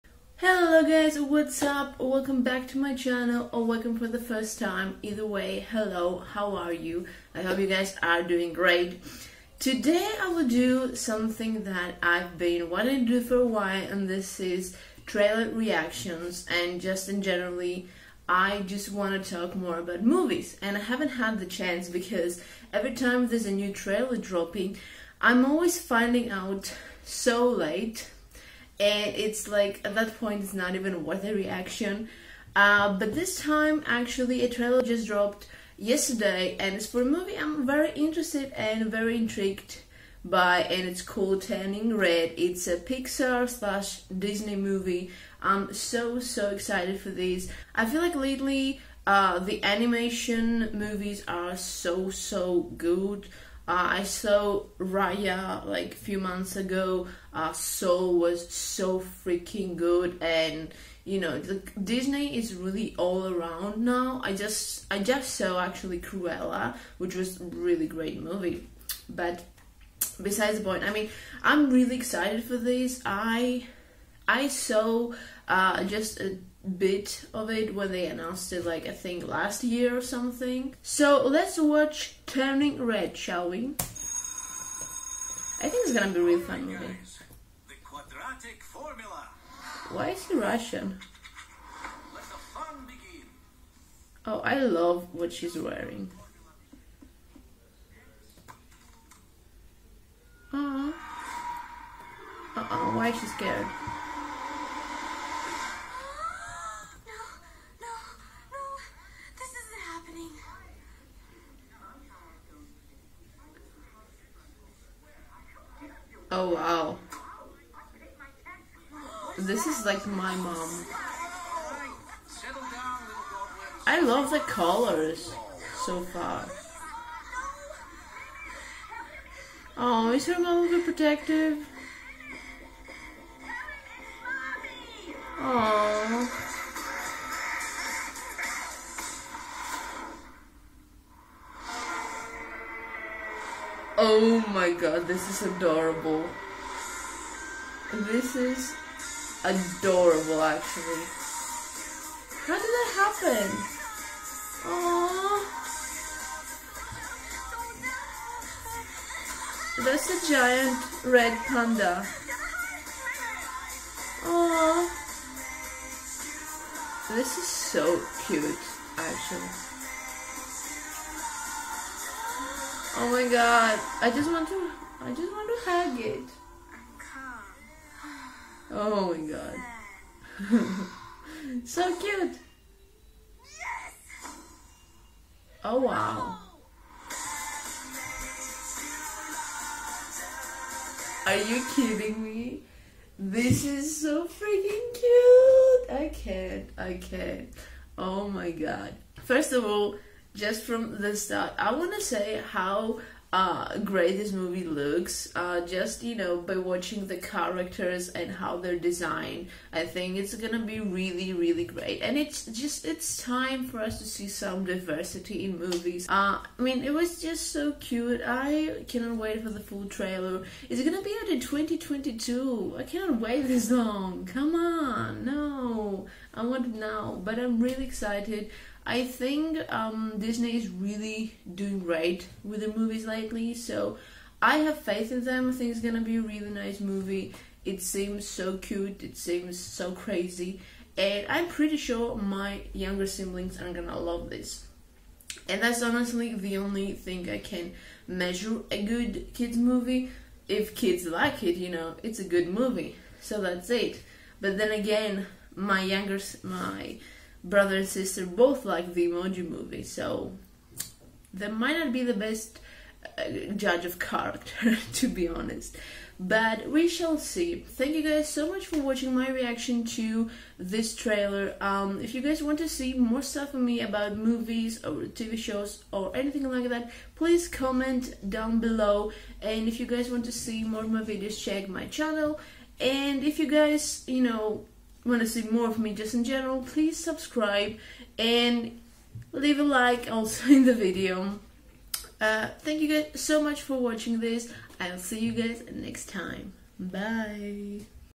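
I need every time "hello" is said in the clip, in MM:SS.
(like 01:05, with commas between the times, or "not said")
00:00, 00:05.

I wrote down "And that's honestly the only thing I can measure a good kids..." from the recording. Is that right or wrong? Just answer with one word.
right.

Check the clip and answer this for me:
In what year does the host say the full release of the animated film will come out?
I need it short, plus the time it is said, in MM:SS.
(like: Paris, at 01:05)
2022, at 03:41.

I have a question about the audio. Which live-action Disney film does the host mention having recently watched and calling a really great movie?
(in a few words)
Cruella.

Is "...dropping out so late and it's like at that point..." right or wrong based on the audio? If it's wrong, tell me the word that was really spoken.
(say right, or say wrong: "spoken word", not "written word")
wrong: "finding", not "dropping".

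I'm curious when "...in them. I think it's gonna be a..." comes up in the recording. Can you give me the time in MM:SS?
03:55.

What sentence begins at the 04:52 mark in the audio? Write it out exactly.
Uh, thank you guys so much for watching this.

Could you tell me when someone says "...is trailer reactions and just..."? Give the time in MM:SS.
00:14.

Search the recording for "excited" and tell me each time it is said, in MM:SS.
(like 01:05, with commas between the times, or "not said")
00:46, 01:11, 03:47.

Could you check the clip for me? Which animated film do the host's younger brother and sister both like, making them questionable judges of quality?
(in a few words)
The Emoji Movie.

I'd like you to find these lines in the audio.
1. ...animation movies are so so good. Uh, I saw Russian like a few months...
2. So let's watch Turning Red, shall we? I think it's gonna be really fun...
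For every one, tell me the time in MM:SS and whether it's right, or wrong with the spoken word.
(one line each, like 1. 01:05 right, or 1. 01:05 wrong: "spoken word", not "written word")
1. 00:49 wrong: "Raya", not "Russian"
2. 01:20 right.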